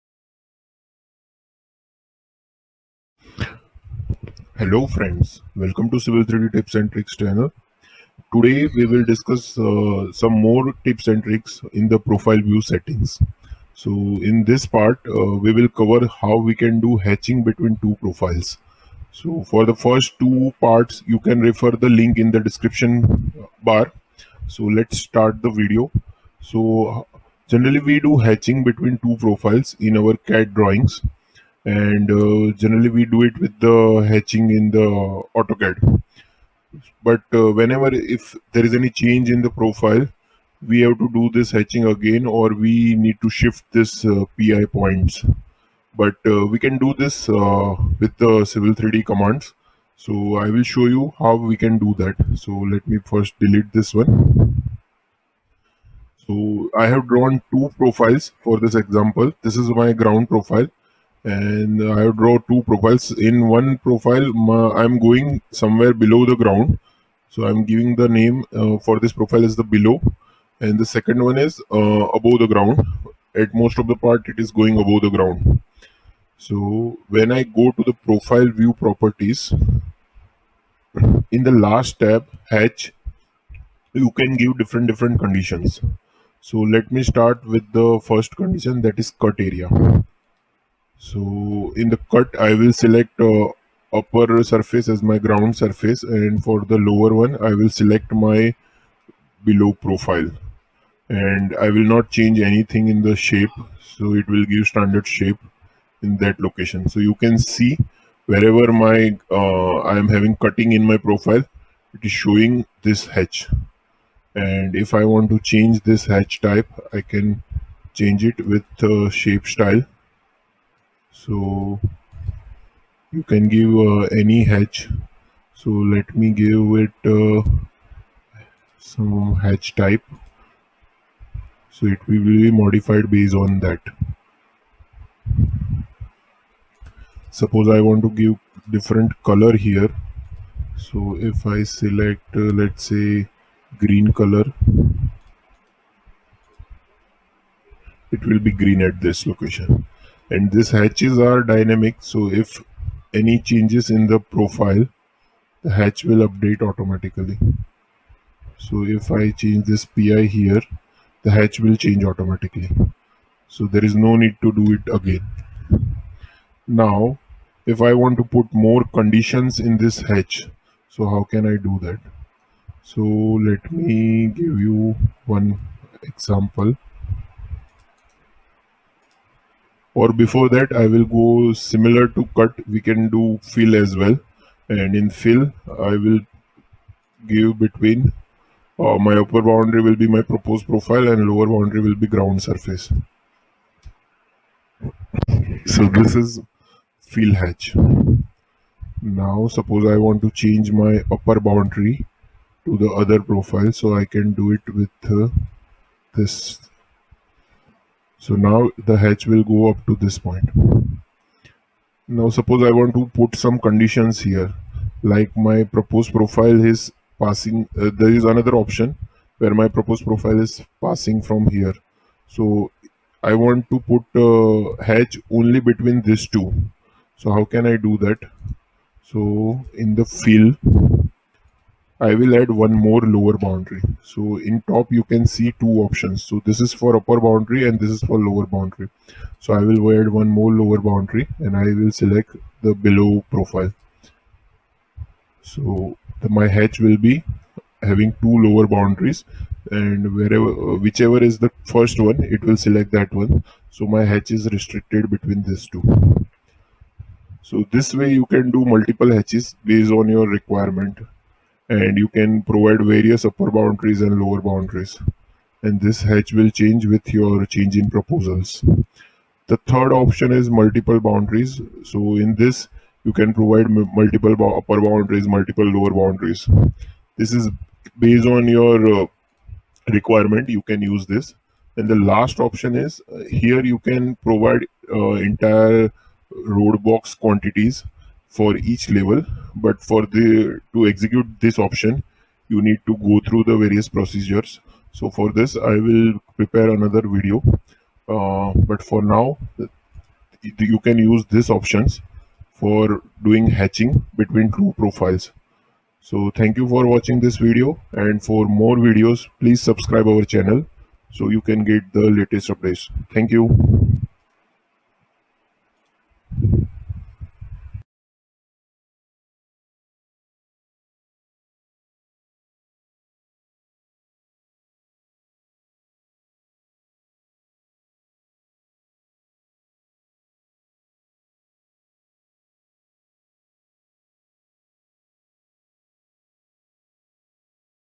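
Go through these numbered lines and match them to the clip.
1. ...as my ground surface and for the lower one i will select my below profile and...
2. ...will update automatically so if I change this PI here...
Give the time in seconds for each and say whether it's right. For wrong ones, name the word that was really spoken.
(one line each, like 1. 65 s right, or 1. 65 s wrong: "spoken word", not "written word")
1. 94 s right
2. 156 s right.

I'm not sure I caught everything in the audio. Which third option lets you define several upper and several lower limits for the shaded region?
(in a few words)
multiple boundaries.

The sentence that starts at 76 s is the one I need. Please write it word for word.
So when I go to the profile view properties, in the last tab, H, you can give different, different conditions.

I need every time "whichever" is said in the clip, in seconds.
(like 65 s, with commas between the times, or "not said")
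250 s.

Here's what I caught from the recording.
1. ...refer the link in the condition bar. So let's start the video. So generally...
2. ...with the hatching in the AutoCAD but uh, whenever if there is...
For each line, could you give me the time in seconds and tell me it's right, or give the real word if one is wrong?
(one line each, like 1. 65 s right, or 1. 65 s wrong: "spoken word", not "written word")
1. 21 s wrong: "description", not "condition"
2. 33 s right.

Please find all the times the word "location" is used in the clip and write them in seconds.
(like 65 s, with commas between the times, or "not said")
106 s, 149 s.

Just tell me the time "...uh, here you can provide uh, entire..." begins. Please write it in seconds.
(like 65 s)
283 s.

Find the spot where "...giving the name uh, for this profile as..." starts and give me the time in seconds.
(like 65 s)
67 s.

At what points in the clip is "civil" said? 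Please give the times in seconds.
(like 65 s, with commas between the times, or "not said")
5 s, 48 s.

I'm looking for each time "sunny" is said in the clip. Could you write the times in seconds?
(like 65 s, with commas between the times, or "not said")
not said.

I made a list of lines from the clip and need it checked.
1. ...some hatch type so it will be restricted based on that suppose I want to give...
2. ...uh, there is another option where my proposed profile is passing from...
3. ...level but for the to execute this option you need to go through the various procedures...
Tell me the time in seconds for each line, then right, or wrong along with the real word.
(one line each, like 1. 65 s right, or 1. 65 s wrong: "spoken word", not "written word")
1. 128 s wrong: "modified", not "restricted"
2. 217 s right
3. 288 s right.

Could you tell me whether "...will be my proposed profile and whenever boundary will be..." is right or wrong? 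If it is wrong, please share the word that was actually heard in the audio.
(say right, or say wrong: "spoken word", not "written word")
wrong: "lower", not "whenever".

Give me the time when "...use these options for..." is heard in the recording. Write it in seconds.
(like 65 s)
301 s.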